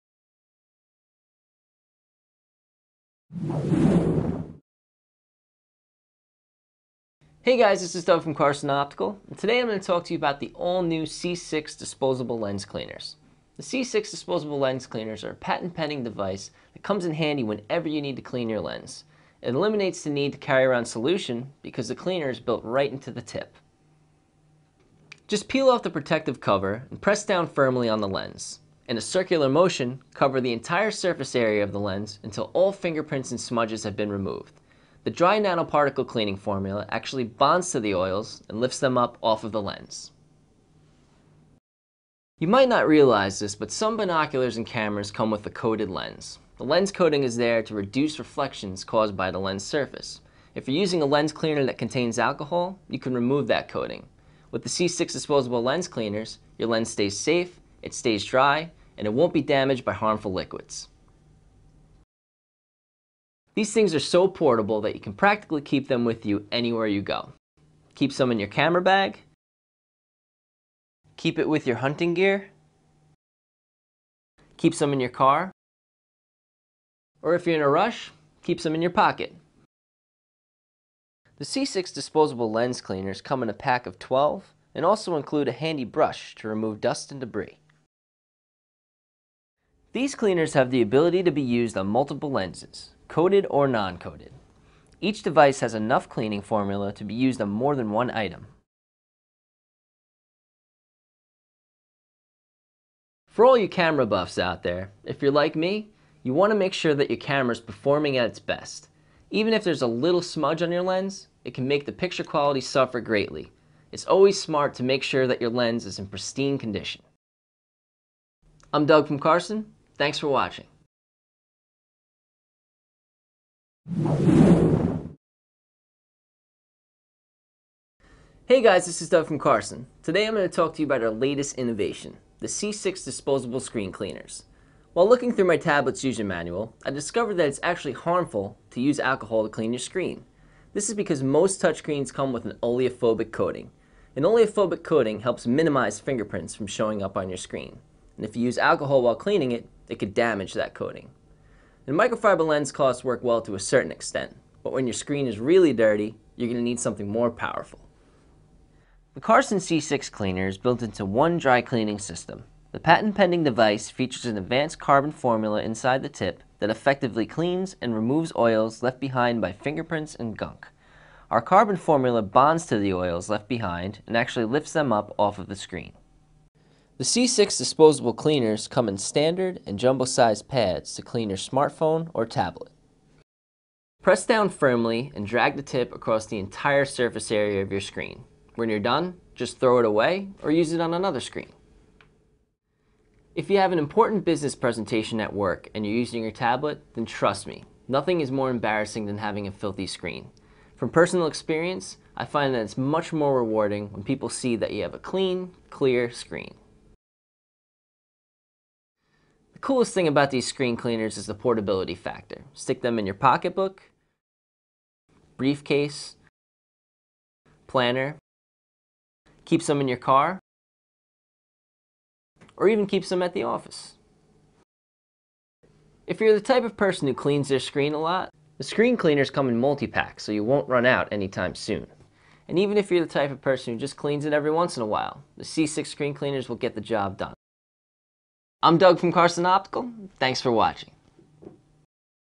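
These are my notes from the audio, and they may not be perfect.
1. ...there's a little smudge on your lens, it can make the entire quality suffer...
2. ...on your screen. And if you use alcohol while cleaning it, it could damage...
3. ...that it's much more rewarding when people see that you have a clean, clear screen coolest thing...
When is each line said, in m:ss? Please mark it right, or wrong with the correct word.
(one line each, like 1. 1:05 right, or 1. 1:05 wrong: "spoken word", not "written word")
1. 1:49 wrong: "picture", not "entire"
2. 2:27 right
3. 3:22 right.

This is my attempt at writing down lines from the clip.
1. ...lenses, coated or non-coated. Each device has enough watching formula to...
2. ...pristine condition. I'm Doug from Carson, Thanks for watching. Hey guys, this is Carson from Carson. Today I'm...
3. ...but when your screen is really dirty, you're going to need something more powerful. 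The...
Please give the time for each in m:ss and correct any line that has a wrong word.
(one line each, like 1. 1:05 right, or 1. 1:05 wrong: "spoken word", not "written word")
1. 1:32 wrong: "cleaning", not "watching"
2. 1:56 wrong: "Doug", not "Carson"
3. 2:34 right.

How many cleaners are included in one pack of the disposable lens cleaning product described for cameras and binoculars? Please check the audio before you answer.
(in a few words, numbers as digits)
12.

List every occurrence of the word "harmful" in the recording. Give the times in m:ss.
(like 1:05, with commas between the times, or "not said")
0:59, 2:17.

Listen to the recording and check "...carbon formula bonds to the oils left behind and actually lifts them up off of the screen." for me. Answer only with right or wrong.
right.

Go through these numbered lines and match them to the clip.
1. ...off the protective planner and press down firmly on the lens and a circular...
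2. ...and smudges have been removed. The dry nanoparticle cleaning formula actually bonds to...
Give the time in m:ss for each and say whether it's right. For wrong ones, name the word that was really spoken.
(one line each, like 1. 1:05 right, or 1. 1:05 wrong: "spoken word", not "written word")
1. 0:25 wrong: "cover", not "planner"
2. 0:33 right.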